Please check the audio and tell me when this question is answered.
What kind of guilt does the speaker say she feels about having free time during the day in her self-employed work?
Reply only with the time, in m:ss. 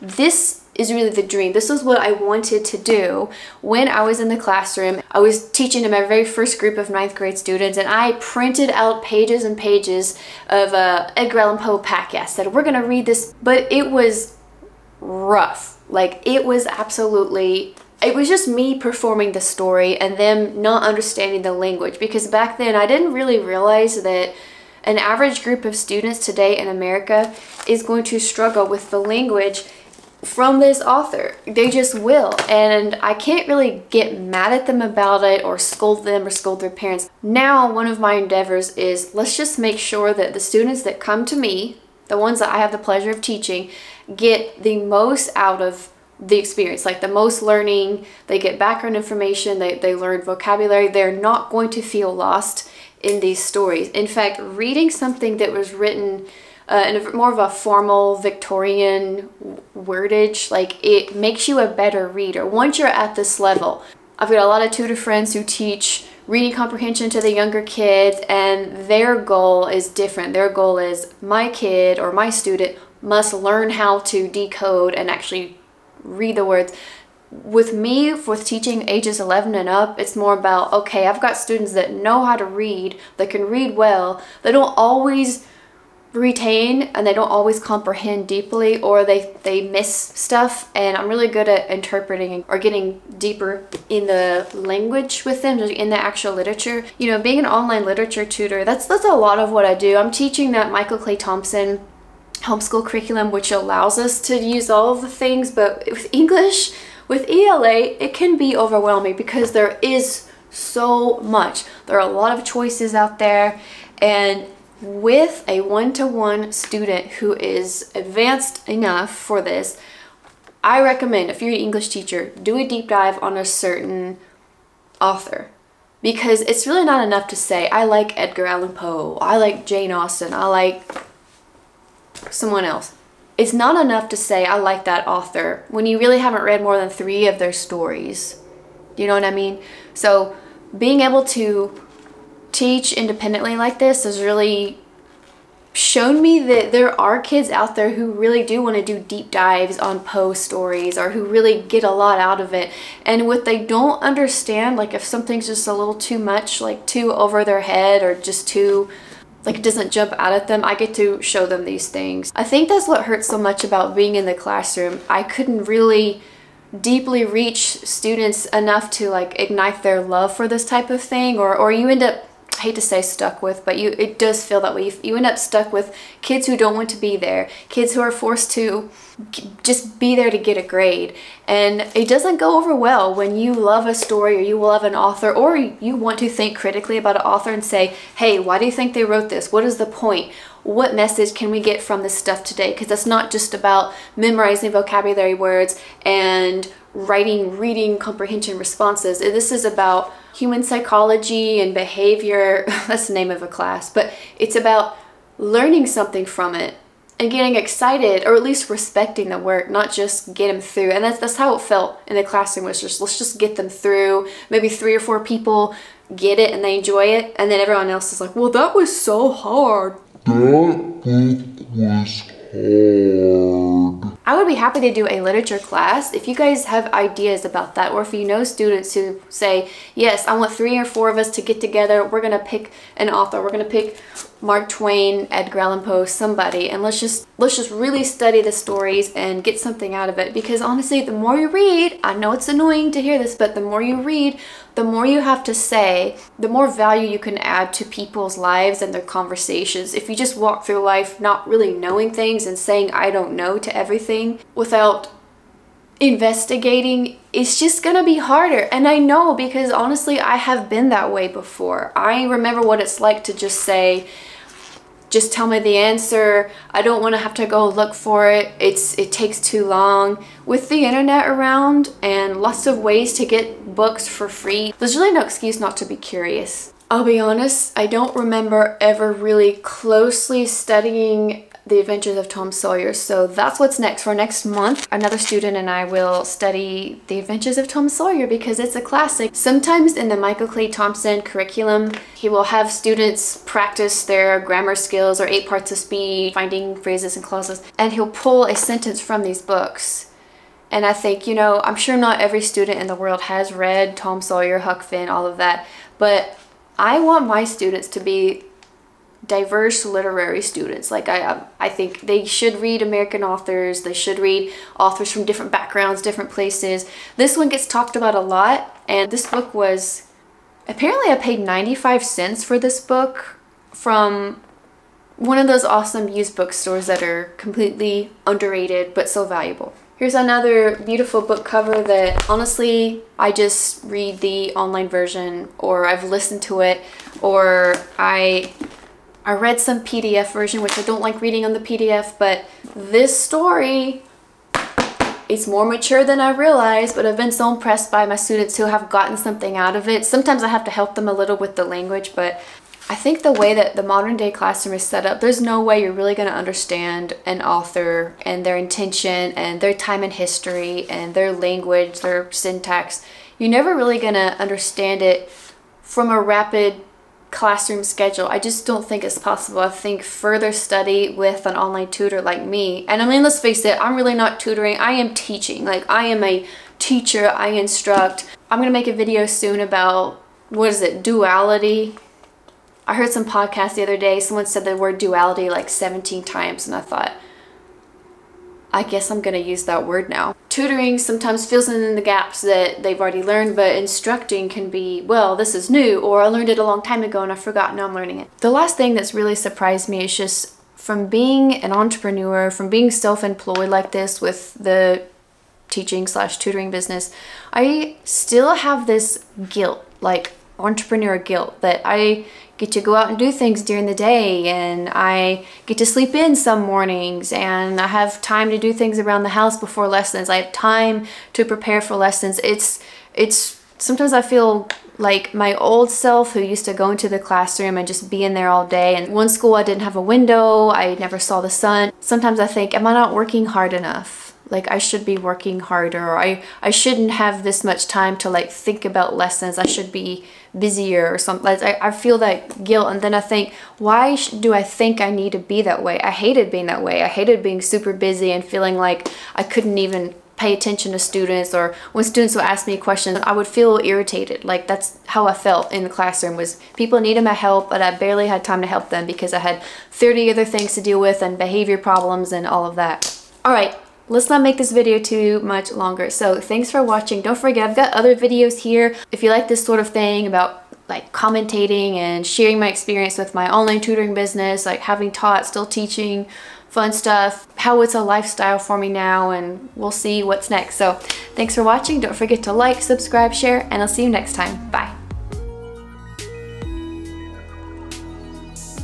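6:50.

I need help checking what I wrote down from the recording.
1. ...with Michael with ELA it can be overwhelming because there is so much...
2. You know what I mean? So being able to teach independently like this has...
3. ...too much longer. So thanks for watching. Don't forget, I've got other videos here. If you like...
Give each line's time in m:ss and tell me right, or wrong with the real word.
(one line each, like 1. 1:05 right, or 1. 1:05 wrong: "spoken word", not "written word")
1. 1:45 wrong: "English", not "Michael"
2. 2:18 right
3. 7:44 right.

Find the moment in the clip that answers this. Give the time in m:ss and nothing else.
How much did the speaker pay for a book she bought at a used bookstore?
5:21.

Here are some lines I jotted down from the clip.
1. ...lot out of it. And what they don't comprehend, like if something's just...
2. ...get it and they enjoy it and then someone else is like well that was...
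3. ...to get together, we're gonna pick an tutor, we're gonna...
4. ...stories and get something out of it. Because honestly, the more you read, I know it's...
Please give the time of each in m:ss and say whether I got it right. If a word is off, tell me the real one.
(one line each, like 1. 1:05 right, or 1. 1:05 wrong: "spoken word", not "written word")
1. 2:31 wrong: "understand", not "comprehend"
2. 3:36 wrong: "everyone", not "someone"
3. 3:51 wrong: "author", not "tutor"
4. 3:58 right.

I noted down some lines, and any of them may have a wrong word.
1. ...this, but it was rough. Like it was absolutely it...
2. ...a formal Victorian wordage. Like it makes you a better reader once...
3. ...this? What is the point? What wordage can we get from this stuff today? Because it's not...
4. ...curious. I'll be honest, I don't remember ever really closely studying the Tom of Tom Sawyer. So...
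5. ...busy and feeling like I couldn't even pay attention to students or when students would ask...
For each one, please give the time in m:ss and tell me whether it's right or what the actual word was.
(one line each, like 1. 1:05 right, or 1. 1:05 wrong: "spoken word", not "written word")
1. 0:13 right
2. 0:57 right
3. 3:09 wrong: "message", not "wordage"
4. 4:35 wrong: "Adventures", not "Tom"
5. 7:27 right.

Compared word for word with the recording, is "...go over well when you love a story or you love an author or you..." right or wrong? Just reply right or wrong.
right.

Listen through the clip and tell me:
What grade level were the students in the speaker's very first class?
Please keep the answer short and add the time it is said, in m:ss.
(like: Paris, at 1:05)
ninth grade, at 0:06.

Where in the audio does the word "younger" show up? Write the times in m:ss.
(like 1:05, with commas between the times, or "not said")
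1:07.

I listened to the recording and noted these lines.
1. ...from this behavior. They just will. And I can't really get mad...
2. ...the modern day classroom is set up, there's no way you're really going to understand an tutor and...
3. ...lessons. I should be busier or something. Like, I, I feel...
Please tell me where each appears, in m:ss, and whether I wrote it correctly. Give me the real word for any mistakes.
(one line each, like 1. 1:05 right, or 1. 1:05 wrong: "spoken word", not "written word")
1. 0:30 wrong: "author", not "behavior"
2. 5:53 wrong: "author", not "tutor"
3. 7:19 right.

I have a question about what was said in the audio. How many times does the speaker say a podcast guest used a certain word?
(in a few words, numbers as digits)
17.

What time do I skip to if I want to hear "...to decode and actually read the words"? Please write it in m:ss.
1:14.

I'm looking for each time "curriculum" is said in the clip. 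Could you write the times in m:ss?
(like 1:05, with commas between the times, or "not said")
1:42, 4:51.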